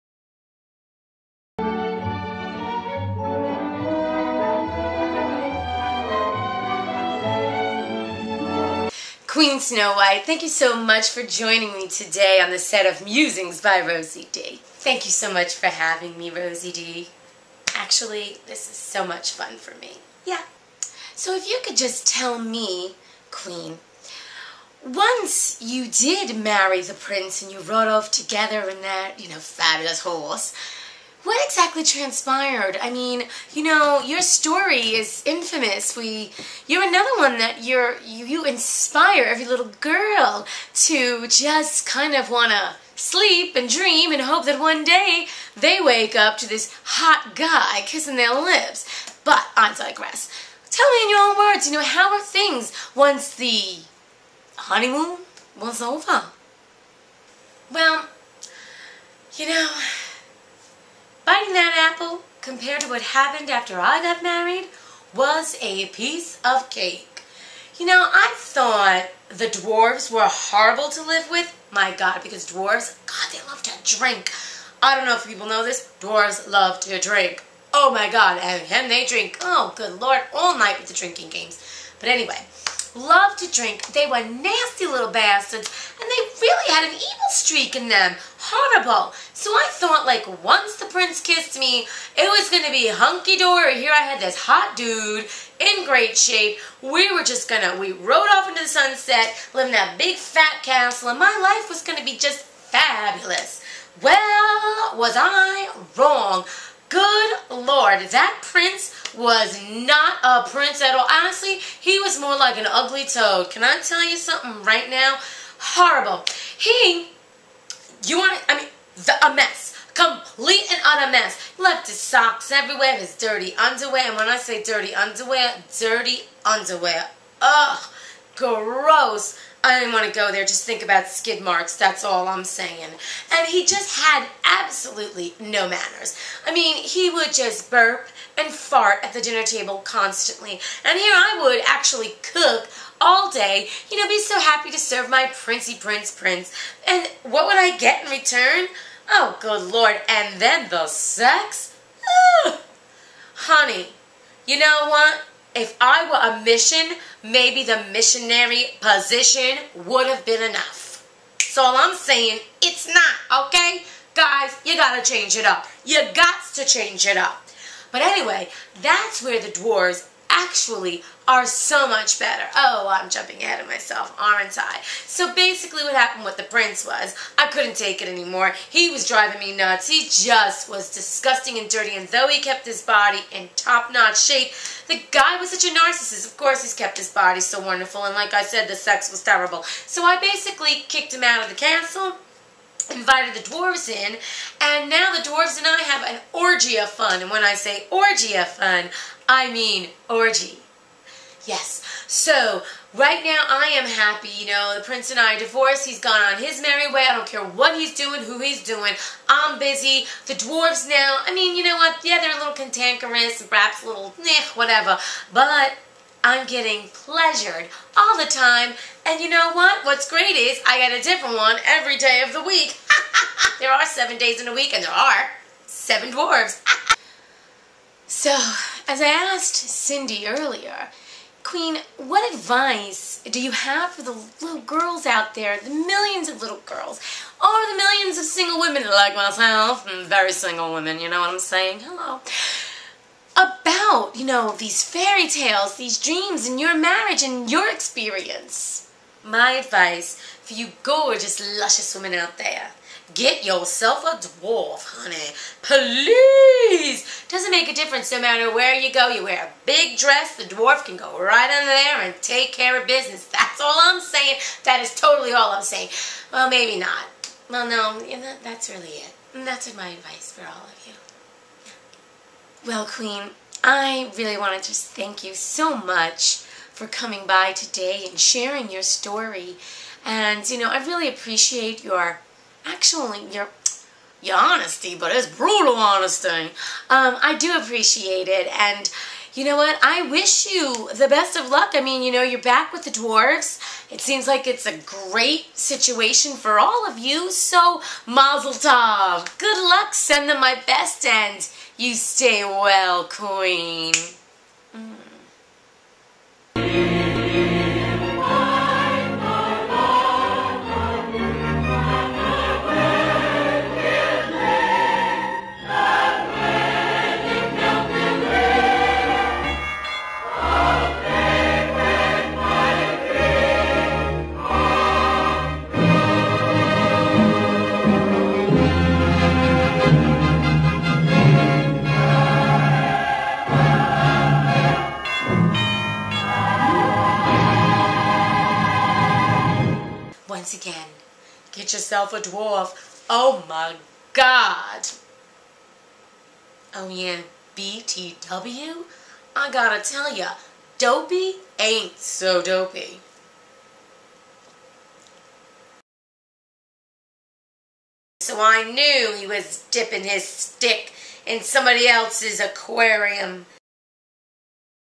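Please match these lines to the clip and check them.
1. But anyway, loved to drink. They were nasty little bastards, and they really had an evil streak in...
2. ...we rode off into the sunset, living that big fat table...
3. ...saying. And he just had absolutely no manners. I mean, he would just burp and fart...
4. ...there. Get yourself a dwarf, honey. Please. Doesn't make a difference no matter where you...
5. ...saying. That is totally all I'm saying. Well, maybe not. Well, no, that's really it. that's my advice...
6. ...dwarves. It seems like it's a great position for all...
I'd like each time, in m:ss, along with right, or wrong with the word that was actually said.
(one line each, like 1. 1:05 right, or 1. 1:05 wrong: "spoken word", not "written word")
1. 1:21 right
2. 1:37 wrong: "castle", not "table"
3. 2:12 right
4. 4:12 right
5. 4:24 right
6. 4:52 wrong: "situation", not "position".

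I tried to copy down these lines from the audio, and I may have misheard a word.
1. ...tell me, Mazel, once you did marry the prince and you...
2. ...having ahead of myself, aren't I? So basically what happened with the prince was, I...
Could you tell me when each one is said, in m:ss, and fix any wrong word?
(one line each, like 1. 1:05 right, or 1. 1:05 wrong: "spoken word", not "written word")
1. 0:22 wrong: "Queen", not "Mazel"
2. 2:53 wrong: "jumping", not "having".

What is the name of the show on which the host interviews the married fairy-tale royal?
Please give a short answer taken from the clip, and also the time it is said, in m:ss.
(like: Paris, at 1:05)
Musings by Rosie Dee, at 0:13.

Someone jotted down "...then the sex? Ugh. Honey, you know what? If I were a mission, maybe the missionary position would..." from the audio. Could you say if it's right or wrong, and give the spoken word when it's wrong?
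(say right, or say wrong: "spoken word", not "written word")
right.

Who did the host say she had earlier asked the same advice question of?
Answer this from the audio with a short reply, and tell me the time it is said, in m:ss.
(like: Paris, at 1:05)
Cindy, at 3:49.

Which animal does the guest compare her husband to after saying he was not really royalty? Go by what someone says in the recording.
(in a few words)
toad.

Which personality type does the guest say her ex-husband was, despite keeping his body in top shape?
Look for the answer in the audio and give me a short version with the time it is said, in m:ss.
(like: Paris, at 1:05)
narcissist, at 3:05.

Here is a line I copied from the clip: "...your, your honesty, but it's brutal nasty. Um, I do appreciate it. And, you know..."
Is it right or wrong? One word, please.
wrong.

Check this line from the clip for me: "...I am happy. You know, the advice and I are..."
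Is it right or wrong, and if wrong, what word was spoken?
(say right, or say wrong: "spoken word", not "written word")
wrong: "prince", not "advice".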